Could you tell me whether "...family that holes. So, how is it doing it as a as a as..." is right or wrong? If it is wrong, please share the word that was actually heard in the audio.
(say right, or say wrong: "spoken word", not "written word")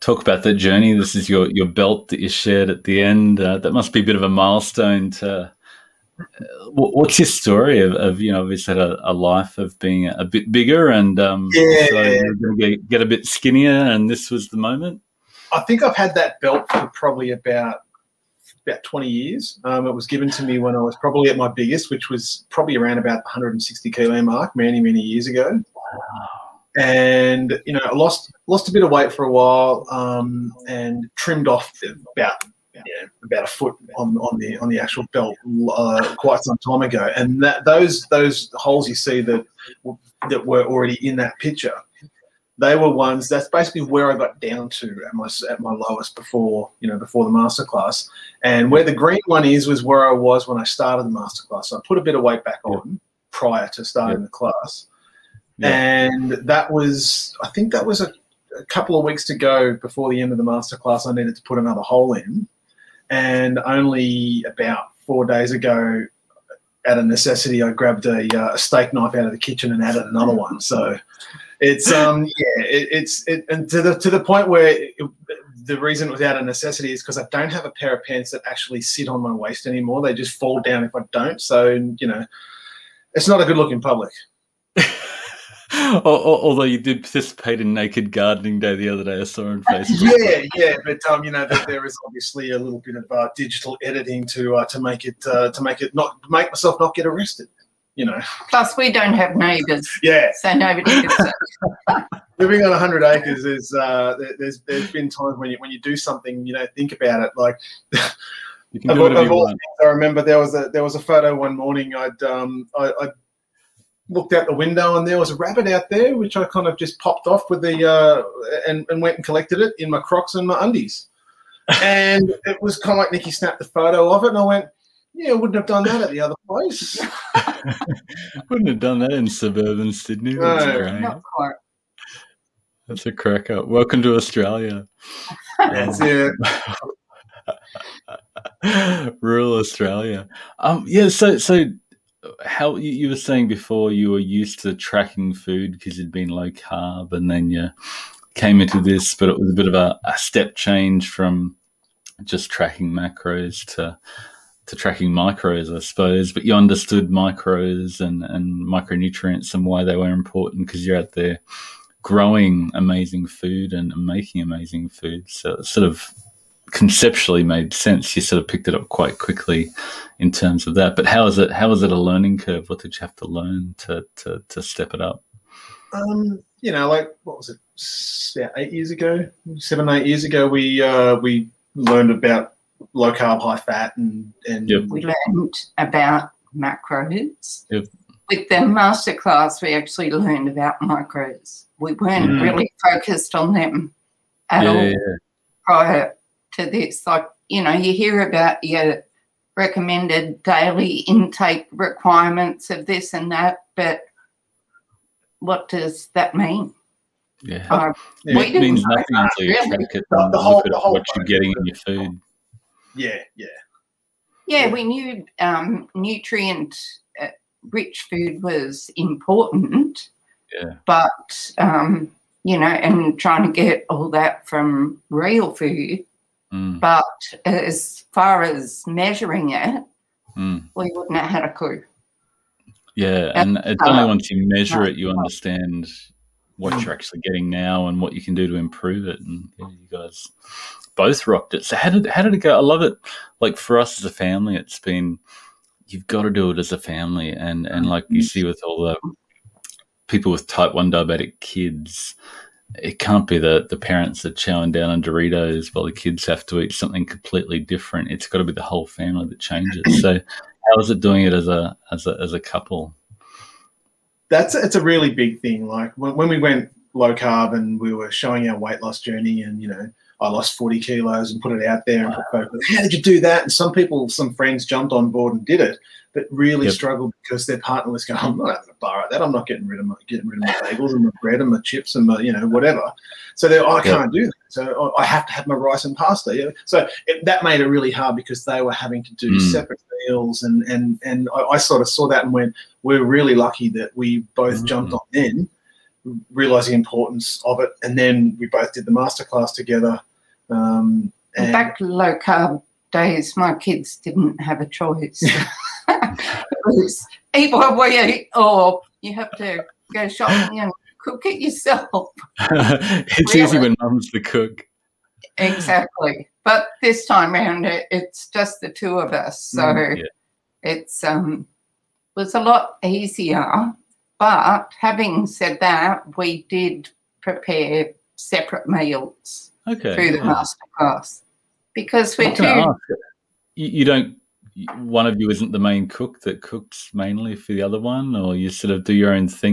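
wrong: "changes", not "holes".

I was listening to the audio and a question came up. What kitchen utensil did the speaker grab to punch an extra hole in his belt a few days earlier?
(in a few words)
steak knife.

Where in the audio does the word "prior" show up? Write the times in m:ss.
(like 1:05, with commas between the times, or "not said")
0:53, 3:15.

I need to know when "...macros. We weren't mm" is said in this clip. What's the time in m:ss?
3:10.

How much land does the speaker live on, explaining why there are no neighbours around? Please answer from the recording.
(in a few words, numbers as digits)
100 acres.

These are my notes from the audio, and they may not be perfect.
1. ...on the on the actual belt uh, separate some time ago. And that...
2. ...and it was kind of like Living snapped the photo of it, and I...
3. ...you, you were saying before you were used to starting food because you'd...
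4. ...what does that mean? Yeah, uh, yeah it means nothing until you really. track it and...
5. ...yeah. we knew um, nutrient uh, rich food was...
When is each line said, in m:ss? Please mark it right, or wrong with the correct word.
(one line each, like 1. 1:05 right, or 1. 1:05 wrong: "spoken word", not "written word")
1. 0:34 wrong: "quite", not "separate"
2. 2:01 wrong: "Nicky", not "Living"
3. 2:22 wrong: "tracking", not "starting"
4. 3:25 right
5. 3:34 right.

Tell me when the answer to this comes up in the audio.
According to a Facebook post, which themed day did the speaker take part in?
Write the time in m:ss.
1:27.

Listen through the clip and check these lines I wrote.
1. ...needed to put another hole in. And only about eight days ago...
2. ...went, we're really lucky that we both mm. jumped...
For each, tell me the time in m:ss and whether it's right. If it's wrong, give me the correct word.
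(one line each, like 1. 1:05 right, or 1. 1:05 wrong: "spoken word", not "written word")
1. 1:01 wrong: "four", not "eight"
2. 4:52 right.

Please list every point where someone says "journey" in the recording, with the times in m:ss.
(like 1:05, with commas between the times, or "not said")
0:00, 4:29.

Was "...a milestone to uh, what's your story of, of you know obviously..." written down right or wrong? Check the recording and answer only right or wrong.
right.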